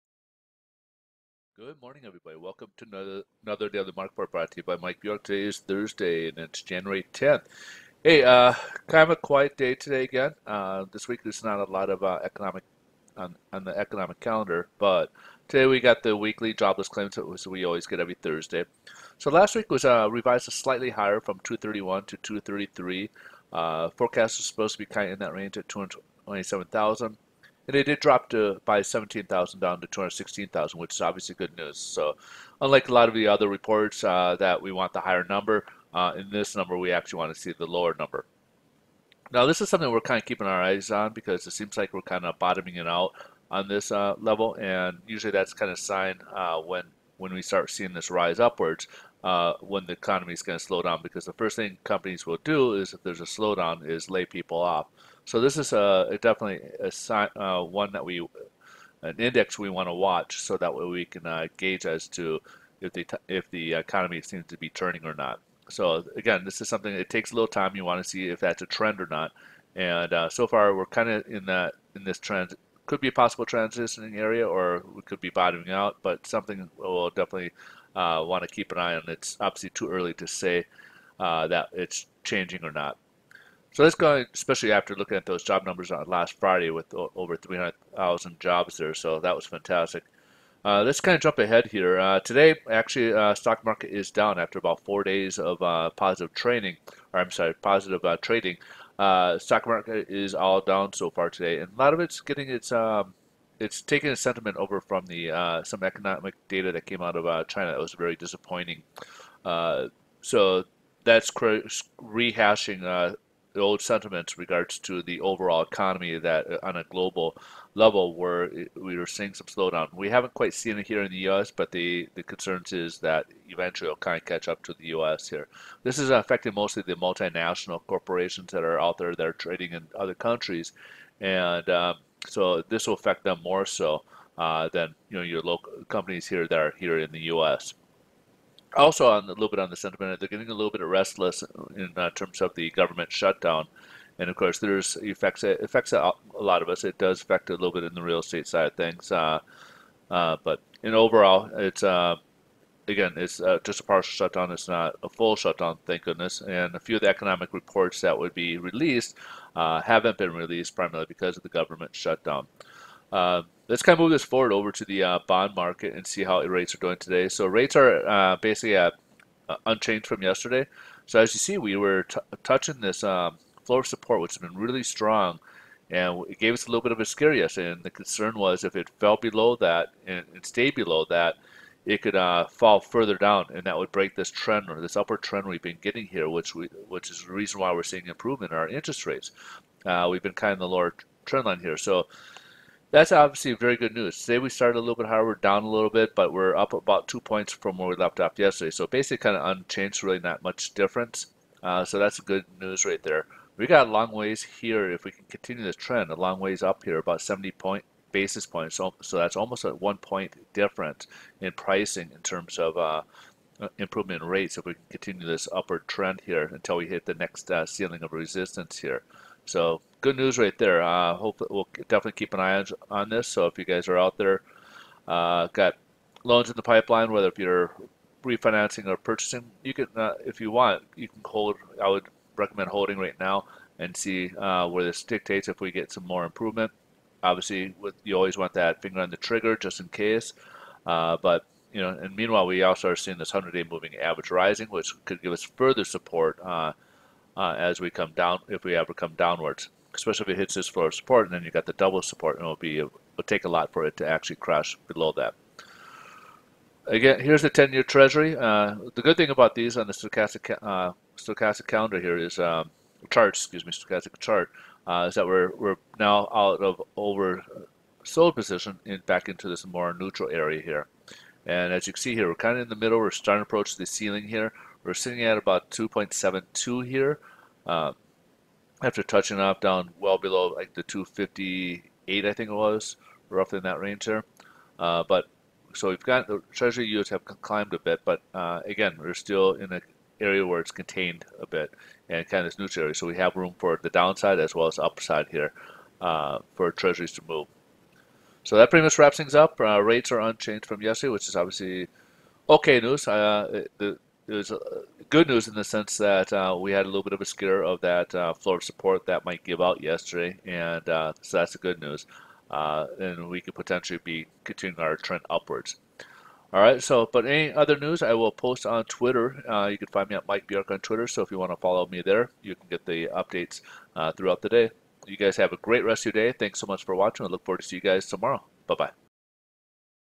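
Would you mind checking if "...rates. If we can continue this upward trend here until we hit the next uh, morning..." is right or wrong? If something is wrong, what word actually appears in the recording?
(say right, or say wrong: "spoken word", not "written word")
wrong: "ceiling", not "morning".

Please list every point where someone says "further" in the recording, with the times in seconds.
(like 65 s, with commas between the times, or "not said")
182 s, 245 s.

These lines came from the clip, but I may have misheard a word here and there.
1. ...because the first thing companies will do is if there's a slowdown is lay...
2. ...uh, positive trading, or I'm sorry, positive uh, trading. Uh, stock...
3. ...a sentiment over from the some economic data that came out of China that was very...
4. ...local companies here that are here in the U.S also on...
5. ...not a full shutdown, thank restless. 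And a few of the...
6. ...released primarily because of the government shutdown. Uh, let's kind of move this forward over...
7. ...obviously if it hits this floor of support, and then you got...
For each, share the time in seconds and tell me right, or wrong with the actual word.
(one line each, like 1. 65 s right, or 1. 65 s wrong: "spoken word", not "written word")
1. 51 s right
2. 95 s right
3. 104 s right
4. 135 s right
5. 154 s wrong: "goodness", not "restless"
6. 160 s right
7. 249 s wrong: "especially", not "obviously".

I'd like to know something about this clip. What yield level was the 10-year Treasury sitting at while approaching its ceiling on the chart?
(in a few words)
2.72.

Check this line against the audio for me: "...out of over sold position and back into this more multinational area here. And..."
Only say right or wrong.
wrong.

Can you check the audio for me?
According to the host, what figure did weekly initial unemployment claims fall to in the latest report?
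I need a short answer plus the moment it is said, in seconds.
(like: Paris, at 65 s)
216,000, at 29 s.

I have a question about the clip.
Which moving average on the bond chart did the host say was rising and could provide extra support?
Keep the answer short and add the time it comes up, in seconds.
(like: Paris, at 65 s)
100-day, at 243 s.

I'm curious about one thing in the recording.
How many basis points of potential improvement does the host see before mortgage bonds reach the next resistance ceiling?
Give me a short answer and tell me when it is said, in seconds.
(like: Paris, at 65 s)
70, at 207 s.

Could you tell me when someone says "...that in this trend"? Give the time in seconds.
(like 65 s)
71 s.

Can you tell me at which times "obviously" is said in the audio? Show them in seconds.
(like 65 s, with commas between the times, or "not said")
31 s, 79 s, 193 s, 237 s, 301 s.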